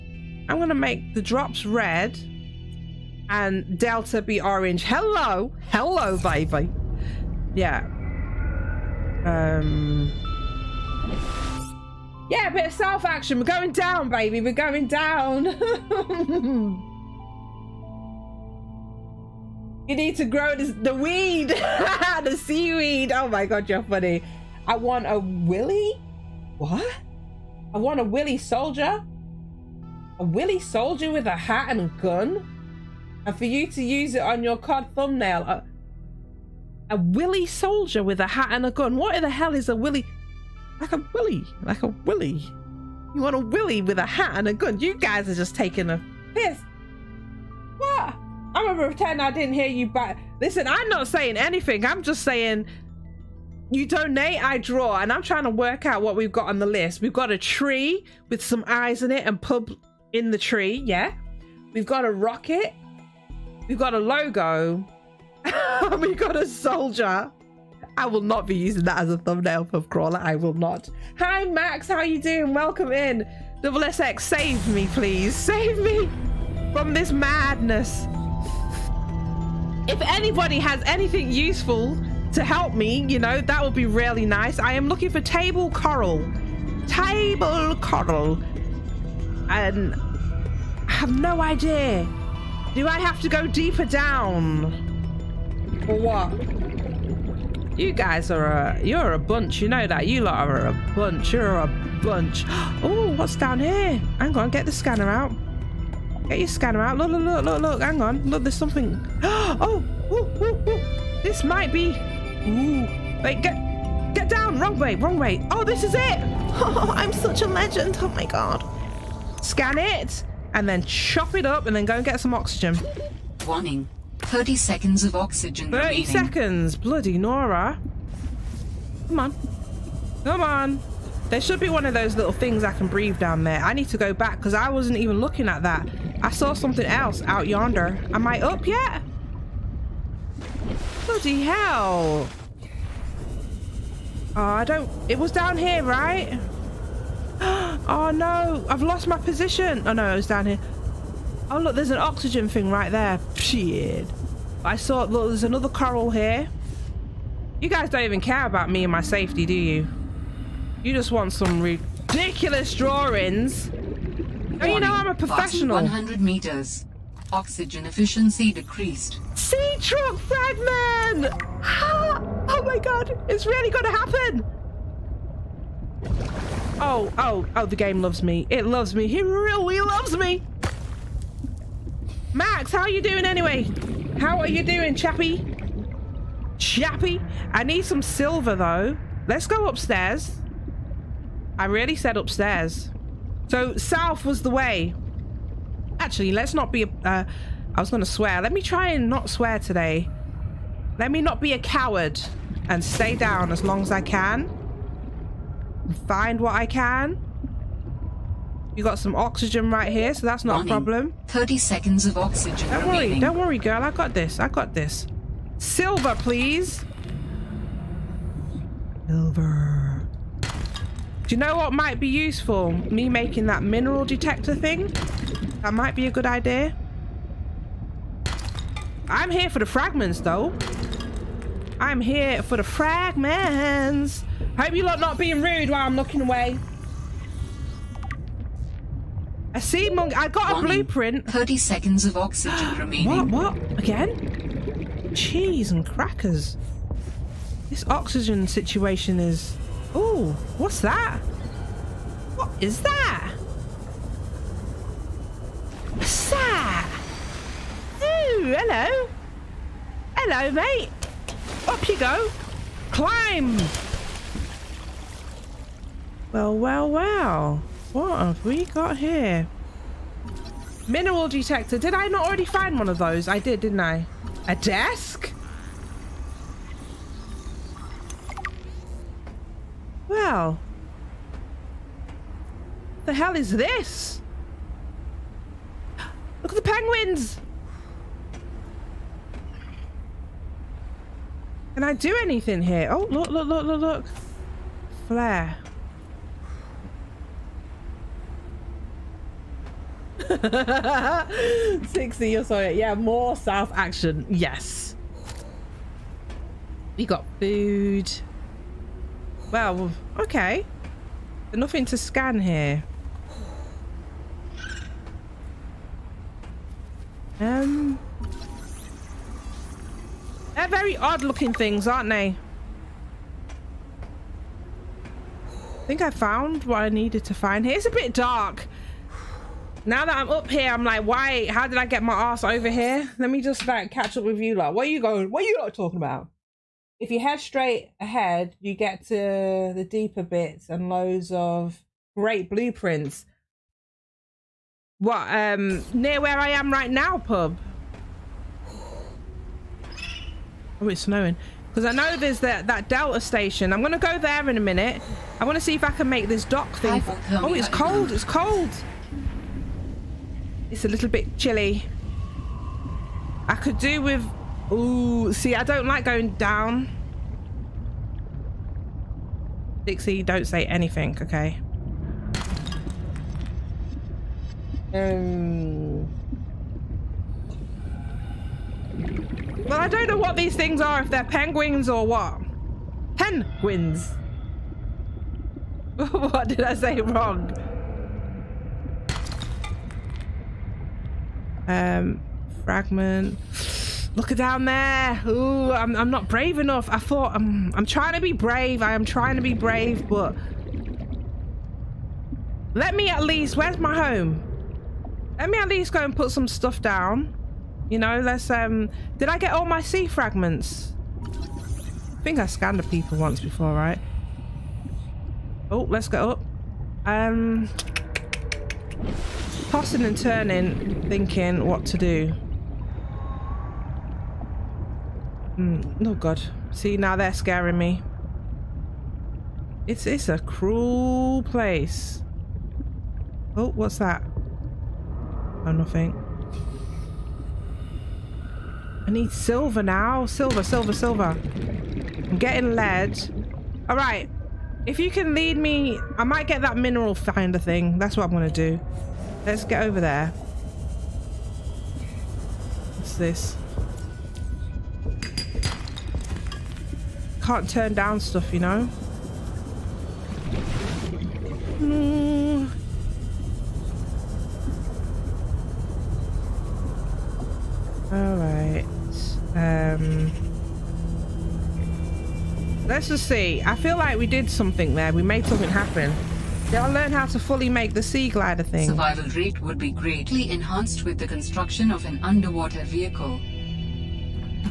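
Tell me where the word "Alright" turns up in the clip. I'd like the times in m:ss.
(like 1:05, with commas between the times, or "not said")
7:48.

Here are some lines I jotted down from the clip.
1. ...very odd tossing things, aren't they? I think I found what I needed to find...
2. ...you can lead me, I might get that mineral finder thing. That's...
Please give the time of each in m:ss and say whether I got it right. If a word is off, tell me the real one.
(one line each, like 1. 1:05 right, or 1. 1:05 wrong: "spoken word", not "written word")
1. 5:20 wrong: "looking", not "tossing"
2. 7:24 right.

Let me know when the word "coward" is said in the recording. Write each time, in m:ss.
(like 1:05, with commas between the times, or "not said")
3:21.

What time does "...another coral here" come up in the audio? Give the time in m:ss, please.
2:35.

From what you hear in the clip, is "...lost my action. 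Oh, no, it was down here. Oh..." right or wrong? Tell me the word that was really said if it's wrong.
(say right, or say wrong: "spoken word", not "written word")
wrong: "position", not "action".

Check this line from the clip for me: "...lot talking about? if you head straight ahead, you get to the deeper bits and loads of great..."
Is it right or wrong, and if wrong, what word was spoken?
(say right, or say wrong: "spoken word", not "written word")
right.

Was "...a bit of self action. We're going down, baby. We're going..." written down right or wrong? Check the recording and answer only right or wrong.
right.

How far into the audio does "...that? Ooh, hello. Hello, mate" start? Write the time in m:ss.
4:16.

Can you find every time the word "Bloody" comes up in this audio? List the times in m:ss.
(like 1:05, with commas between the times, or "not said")
2:06, 2:21.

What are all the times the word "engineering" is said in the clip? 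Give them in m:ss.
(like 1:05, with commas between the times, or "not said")
not said.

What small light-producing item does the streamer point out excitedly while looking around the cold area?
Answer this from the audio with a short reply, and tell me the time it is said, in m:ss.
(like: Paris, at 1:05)
Flare, at 4:55.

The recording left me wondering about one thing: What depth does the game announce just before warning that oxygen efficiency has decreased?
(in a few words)
100 meters.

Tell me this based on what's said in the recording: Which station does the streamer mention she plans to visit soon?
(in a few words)
Delta station.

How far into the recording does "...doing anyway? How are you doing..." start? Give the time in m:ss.
3:03.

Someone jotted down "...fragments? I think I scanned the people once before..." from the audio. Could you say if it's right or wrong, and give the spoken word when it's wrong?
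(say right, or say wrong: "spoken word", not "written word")
right.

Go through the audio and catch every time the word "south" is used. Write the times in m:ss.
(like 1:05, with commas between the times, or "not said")
3:13, 5:03.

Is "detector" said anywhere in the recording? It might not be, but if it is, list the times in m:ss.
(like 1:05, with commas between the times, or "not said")
3:44, 4:31.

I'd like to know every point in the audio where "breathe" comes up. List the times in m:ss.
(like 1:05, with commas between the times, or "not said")
2:12.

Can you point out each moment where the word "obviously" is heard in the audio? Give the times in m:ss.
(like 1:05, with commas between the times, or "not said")
not said.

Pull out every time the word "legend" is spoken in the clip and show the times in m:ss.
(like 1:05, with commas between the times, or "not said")
1:57.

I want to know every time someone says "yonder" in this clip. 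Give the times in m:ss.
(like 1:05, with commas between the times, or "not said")
2:17.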